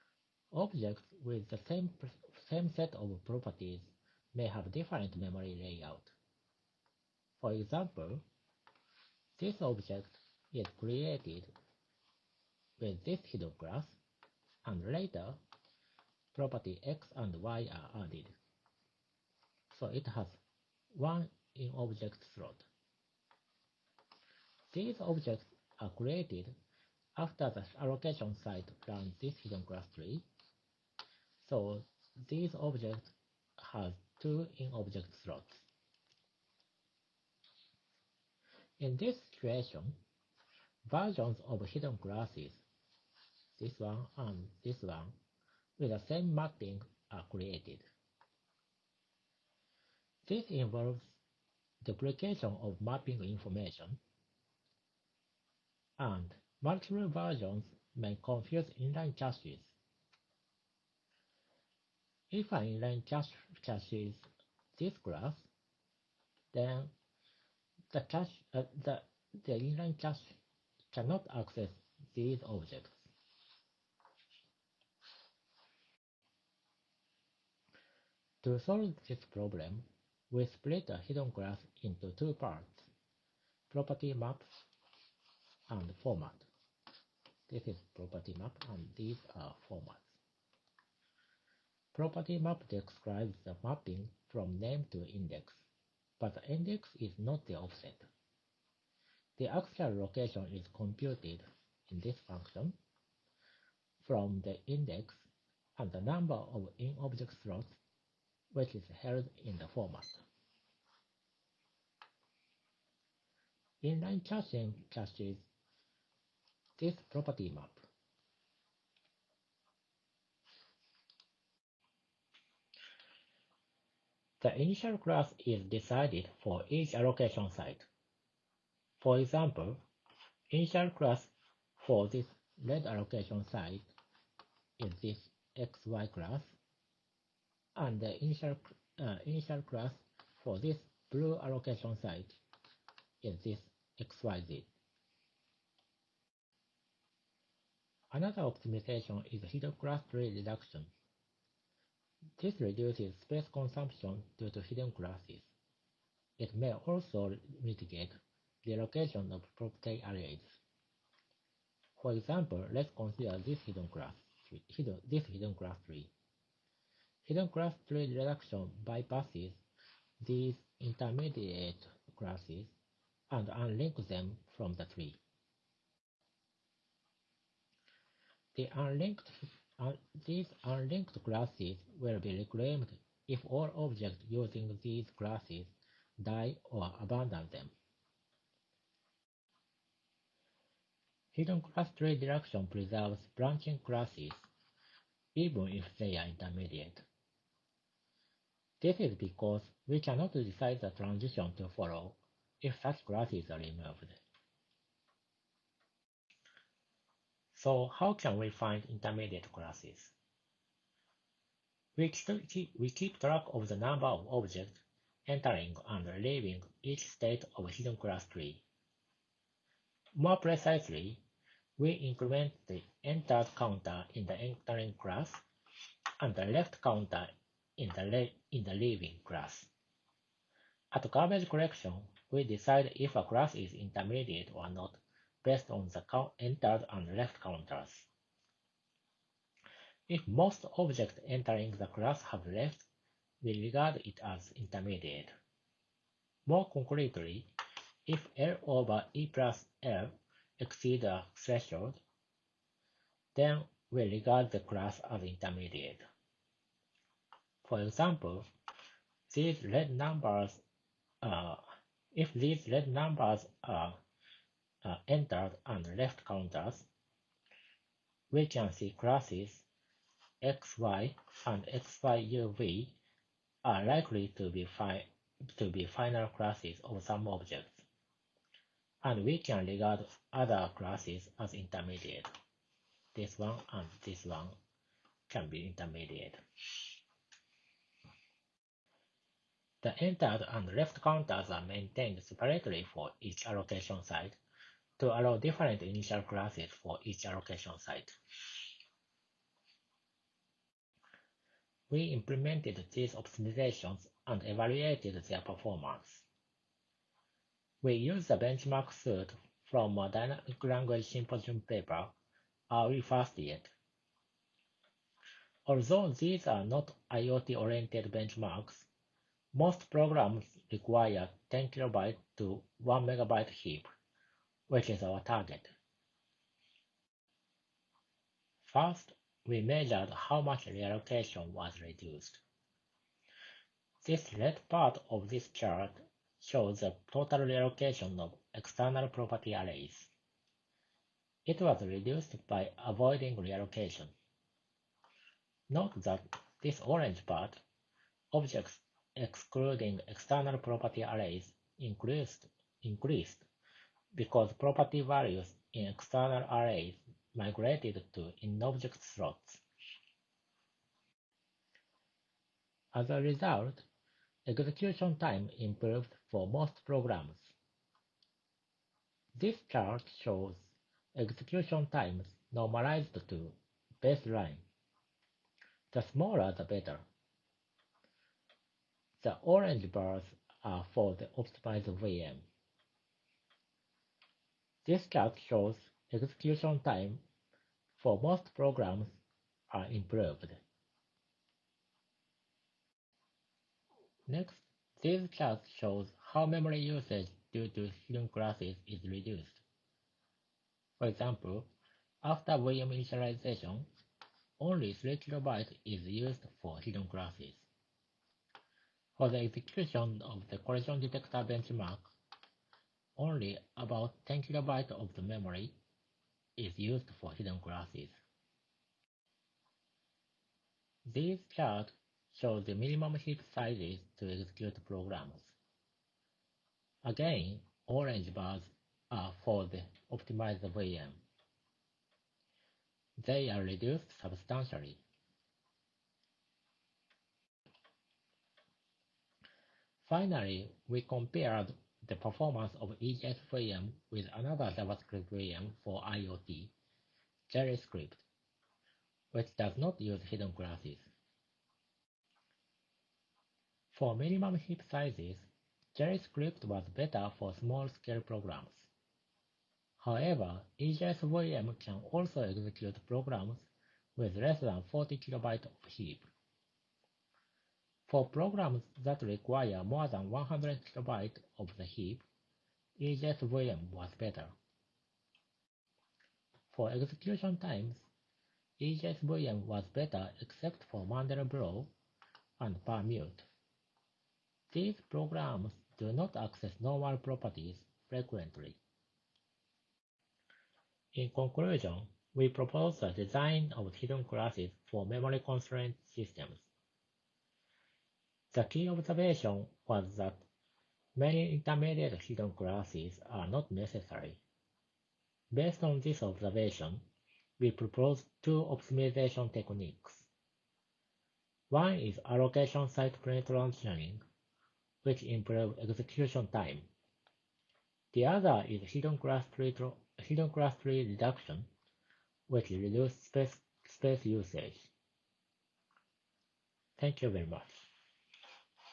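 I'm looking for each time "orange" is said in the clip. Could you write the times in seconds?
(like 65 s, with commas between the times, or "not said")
346 s, 379 s, 427 s.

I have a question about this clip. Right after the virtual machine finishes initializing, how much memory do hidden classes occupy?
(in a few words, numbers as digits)
3 KB.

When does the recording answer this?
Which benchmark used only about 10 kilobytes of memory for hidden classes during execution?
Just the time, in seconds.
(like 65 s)
410 s.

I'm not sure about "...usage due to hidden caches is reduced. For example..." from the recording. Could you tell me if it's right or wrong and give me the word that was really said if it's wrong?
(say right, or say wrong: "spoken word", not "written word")
wrong: "classes", not "caches".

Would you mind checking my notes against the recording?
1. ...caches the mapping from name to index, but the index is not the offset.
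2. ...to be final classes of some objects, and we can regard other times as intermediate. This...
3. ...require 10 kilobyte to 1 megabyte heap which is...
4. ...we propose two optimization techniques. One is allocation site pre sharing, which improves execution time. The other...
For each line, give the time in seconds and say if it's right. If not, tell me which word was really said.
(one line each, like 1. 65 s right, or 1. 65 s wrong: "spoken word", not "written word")
1. 92 s wrong: "describes", not "caches"
2. 275 s wrong: "classes", not "times"
3. 320 s right
4. 507 s right.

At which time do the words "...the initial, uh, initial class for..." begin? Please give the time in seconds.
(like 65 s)
137 s.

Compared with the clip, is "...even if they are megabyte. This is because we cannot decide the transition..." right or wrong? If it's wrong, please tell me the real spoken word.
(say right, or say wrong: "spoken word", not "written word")
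wrong: "intermediate", not "megabyte".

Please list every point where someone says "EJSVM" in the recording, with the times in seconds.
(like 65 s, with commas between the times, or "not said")
473 s, 478 s.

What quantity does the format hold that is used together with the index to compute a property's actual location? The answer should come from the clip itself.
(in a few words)
Number of in-object slots.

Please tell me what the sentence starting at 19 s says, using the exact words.
So it has one in object slot.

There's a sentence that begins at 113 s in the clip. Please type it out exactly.
Inline caching caches this property map.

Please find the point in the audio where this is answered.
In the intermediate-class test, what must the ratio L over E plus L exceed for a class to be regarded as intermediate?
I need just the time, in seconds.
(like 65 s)
251 s.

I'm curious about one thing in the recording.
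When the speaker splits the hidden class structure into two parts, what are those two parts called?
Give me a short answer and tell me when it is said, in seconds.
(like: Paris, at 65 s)
Property maps and format, at 83 s.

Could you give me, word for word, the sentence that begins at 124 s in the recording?
The initial class is decided for each allocation site.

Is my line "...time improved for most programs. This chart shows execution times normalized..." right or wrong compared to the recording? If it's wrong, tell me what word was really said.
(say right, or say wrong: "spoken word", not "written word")
right.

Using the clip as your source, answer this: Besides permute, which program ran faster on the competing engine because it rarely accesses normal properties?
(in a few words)
Mandelbrot.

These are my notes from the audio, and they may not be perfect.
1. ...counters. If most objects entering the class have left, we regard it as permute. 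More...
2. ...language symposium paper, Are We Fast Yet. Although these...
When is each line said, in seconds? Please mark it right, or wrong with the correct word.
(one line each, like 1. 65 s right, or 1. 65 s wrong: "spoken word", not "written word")
1. 237 s wrong: "intermediate", not "permute"
2. 310 s right.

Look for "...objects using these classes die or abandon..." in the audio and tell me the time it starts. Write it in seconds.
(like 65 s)
183 s.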